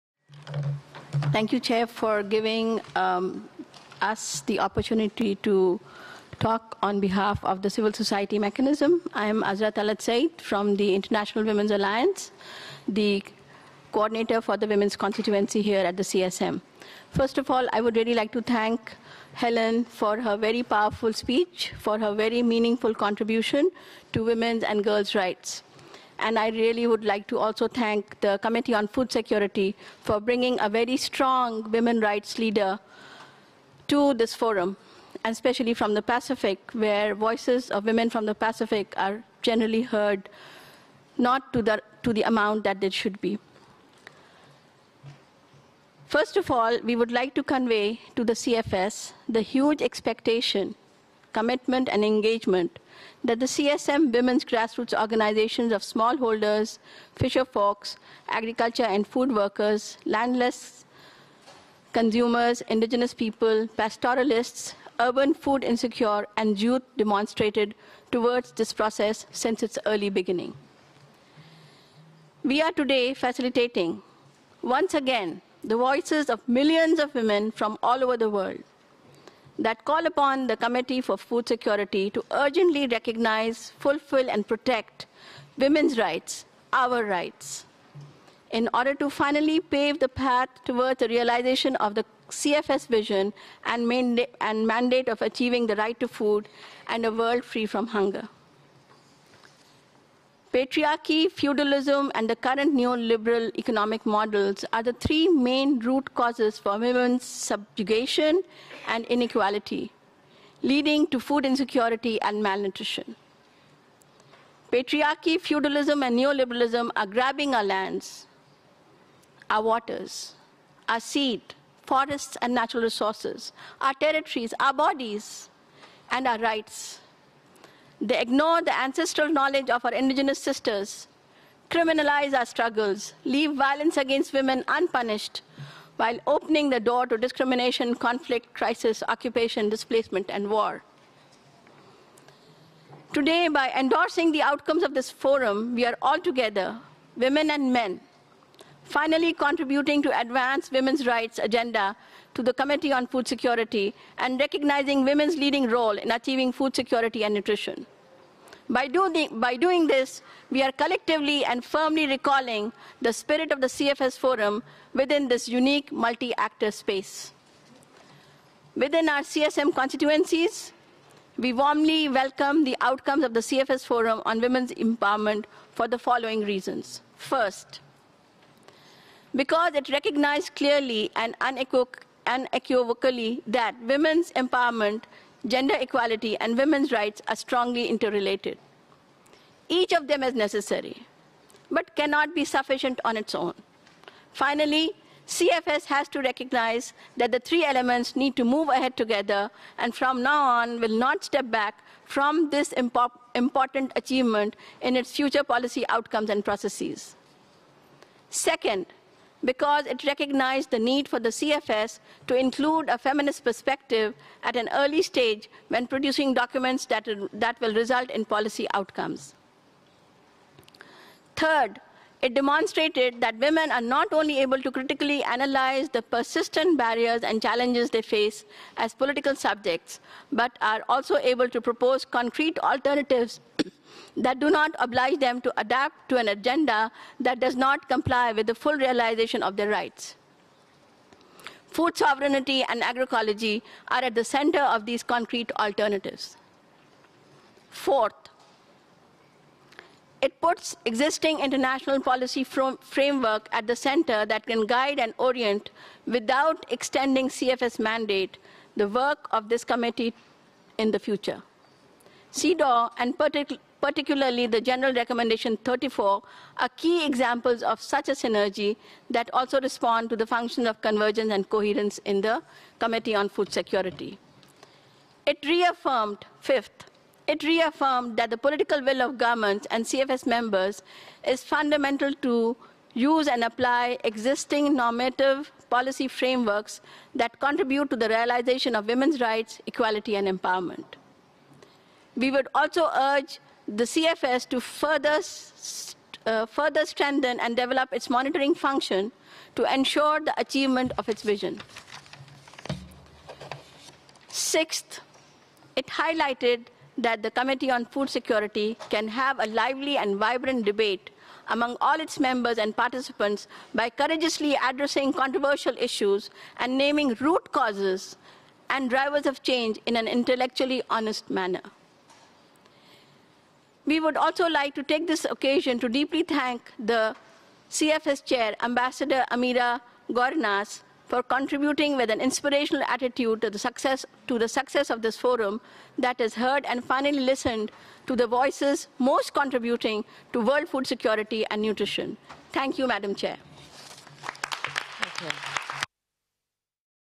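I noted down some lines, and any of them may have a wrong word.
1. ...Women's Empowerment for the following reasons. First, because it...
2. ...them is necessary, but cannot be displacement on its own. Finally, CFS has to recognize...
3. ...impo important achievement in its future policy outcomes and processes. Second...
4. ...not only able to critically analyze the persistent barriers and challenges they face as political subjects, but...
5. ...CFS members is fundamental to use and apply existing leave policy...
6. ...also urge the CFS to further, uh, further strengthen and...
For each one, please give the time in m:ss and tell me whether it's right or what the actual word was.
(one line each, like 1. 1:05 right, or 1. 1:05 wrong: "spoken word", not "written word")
1. 2:54 right
2. 3:10 wrong: "sufficient", not "displacement"
3. 3:22 right
4. 3:43 right
5. 4:39 wrong: "normative", not "leave"
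6. 4:52 right.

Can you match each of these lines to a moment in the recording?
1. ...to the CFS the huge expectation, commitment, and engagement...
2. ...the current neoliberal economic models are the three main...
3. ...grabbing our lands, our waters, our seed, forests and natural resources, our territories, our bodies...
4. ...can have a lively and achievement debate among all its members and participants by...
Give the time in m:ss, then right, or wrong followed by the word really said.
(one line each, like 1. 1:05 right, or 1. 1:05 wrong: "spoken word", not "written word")
1. 0:48 right
2. 1:42 right
3. 1:57 right
4. 5:08 wrong: "vibrant", not "achievement".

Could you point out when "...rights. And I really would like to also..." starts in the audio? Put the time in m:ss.
0:25.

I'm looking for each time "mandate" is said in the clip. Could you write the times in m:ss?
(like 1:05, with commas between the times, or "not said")
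1:34, 4:17.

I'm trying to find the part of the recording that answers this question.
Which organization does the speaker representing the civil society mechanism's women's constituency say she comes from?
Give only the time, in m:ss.
0:10.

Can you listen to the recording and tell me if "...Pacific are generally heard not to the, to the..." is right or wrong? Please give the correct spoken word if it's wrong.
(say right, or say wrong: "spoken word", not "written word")
right.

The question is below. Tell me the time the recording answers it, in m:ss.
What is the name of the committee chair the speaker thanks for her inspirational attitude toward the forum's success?
5:29.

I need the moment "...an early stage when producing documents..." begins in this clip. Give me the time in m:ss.
3:34.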